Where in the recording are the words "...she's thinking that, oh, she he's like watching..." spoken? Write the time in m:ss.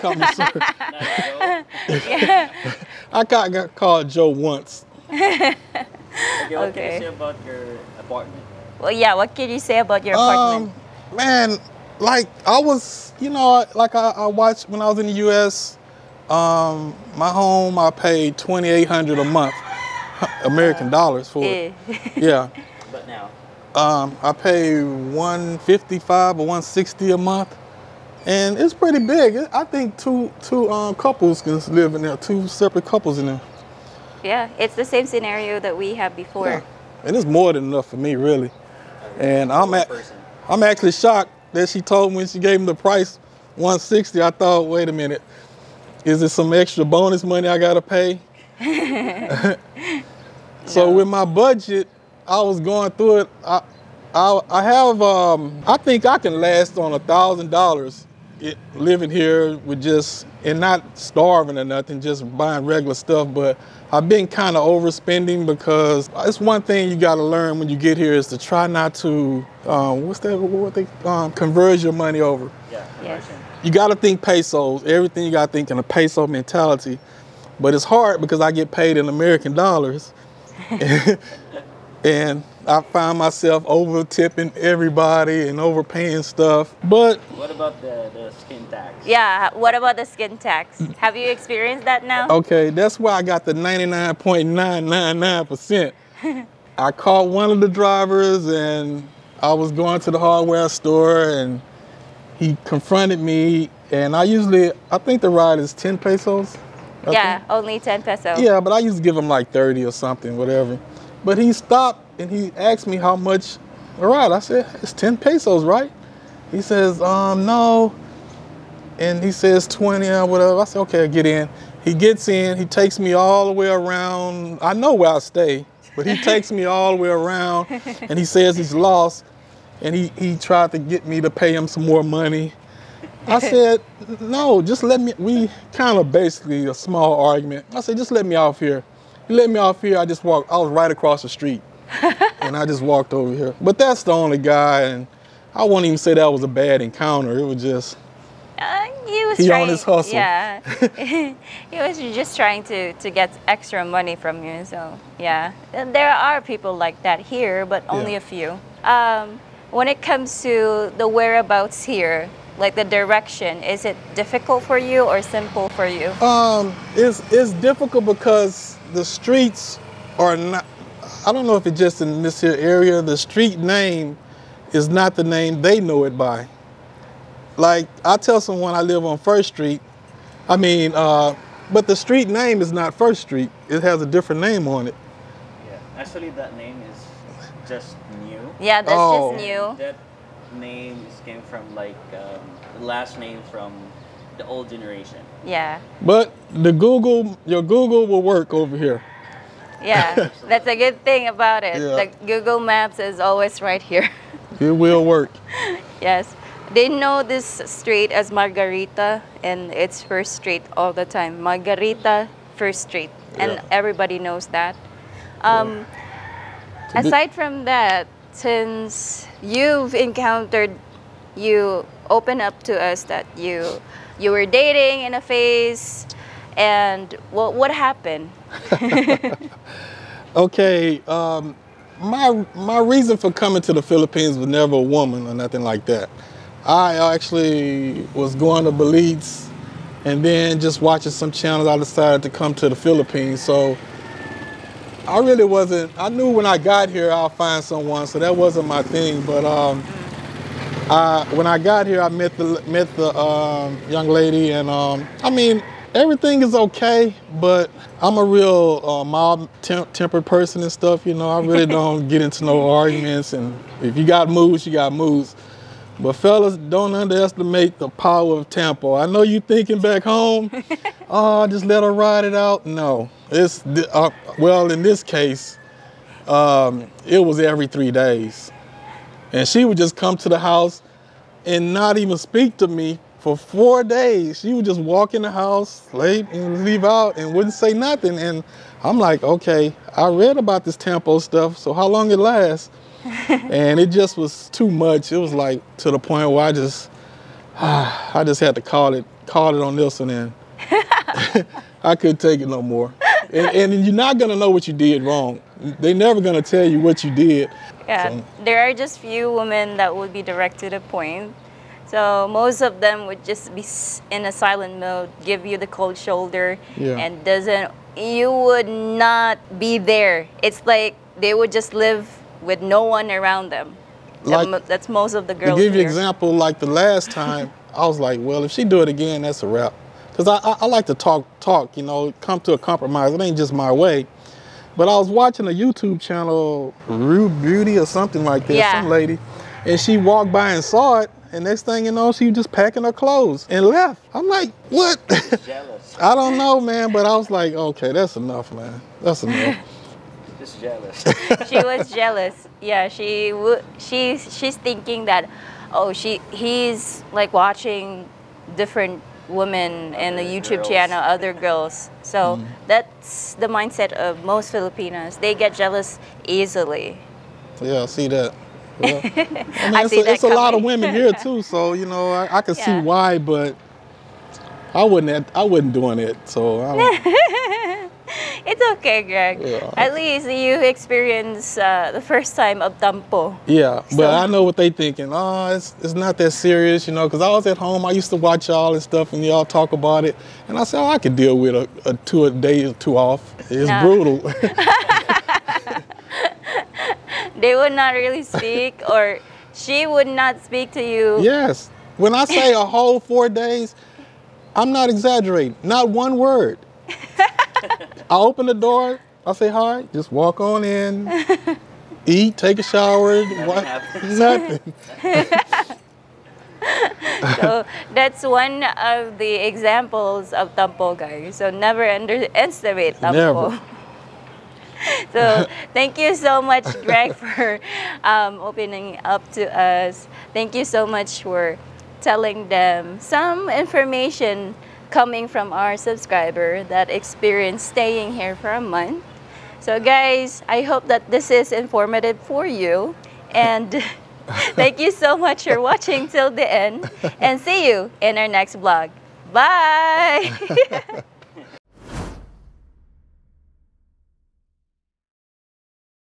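5:54.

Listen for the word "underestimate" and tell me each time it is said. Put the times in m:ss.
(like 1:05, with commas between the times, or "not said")
4:26, 7:01.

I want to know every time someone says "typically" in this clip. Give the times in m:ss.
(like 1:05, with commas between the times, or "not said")
not said.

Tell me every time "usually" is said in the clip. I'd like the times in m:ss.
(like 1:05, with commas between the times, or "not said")
1:44.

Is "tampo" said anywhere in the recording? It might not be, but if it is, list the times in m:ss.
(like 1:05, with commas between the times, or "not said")
4:28, 4:50, 6:22, 7:02.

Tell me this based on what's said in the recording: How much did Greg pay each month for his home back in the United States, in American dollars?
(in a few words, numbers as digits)
2800.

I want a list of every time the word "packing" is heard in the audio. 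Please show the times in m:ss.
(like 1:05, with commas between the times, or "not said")
5:42.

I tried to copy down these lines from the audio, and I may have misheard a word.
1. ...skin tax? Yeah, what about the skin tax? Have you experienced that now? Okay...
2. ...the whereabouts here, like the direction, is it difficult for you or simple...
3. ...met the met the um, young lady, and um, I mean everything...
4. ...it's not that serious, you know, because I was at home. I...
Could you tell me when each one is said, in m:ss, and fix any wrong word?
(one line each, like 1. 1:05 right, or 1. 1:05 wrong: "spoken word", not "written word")
1. 1:28 right
2. 2:40 right
3. 4:12 right
4. 6:25 right.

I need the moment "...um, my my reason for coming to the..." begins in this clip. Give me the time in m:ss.
3:51.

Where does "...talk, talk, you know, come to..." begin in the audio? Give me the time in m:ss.
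5:30.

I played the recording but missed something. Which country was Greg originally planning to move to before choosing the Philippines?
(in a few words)
Belize.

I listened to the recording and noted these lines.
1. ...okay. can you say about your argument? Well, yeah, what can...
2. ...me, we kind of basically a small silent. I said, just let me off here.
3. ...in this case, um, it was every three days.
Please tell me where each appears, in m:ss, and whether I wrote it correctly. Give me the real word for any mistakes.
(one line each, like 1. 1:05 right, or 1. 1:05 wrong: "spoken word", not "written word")
1. 0:06 wrong: "apartment", not "argument"
2. 2:15 wrong: "argument", not "silent"
3. 4:34 right.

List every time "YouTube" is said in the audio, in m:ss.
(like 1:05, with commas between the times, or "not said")
5:35, 6:00.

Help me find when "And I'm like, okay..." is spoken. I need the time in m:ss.
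4:48.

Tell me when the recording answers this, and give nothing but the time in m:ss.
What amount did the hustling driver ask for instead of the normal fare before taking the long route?
1:59.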